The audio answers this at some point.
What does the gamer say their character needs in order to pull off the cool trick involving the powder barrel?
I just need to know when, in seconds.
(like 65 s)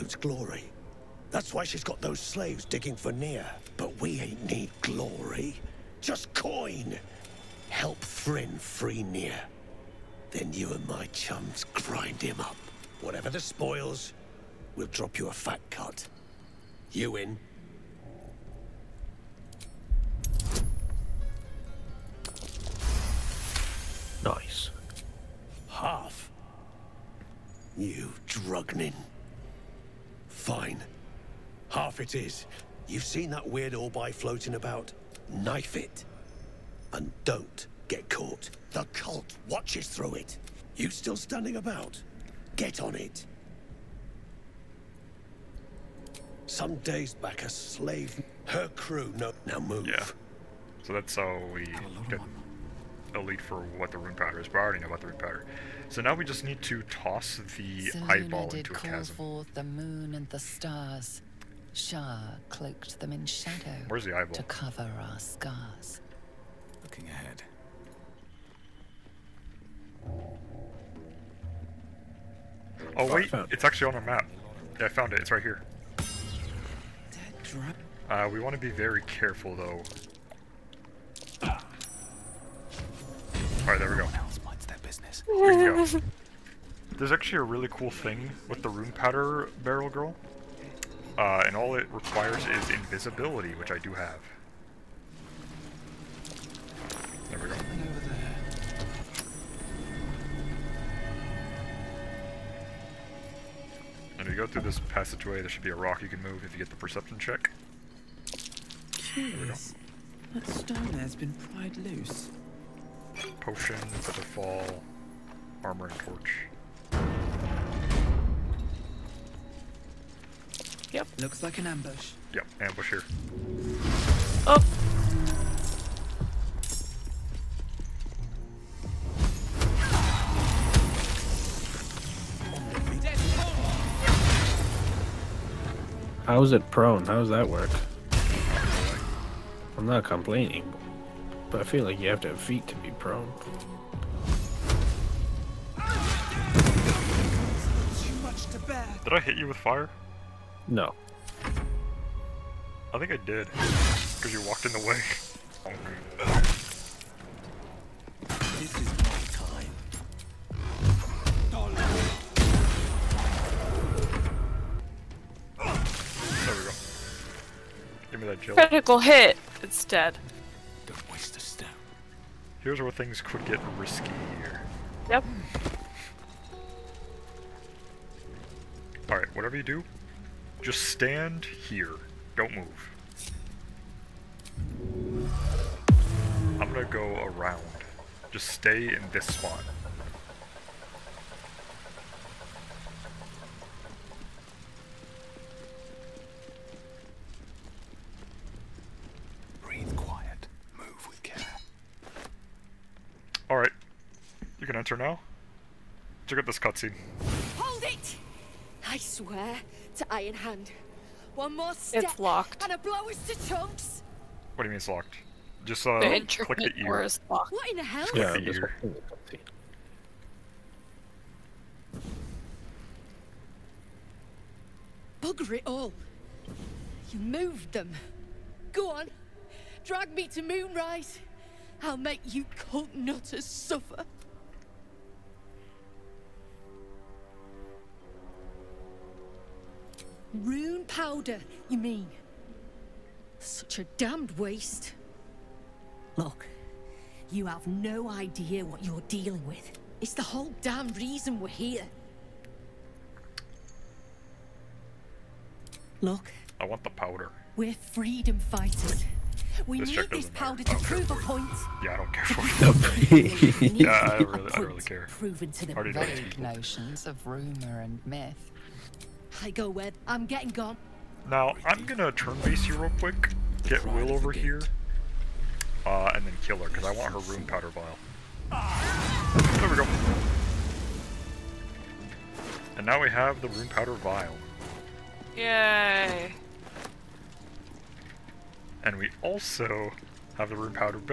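92 s.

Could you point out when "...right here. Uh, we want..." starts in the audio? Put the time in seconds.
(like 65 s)
75 s.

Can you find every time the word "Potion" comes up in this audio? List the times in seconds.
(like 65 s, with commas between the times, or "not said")
113 s.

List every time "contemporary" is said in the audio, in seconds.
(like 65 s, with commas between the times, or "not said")
not said.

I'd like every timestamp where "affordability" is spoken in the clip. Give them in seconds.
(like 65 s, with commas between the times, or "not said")
not said.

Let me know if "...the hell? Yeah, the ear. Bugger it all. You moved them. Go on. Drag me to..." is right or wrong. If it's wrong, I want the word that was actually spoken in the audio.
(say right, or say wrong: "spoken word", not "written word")
right.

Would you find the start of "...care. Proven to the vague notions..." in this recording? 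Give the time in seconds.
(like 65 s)
264 s.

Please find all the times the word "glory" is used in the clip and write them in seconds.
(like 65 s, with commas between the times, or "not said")
0 s, 4 s.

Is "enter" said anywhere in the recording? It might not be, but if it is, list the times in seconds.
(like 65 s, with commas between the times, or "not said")
204 s.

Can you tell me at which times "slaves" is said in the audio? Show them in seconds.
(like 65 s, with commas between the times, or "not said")
2 s, 47 s.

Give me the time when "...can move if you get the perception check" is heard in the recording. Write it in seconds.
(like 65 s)
106 s.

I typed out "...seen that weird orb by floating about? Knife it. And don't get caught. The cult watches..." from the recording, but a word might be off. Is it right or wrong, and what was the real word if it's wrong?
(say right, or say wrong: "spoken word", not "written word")
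right.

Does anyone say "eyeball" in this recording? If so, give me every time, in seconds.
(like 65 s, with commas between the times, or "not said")
58 s, 64 s.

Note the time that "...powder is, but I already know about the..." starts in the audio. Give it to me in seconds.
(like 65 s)
54 s.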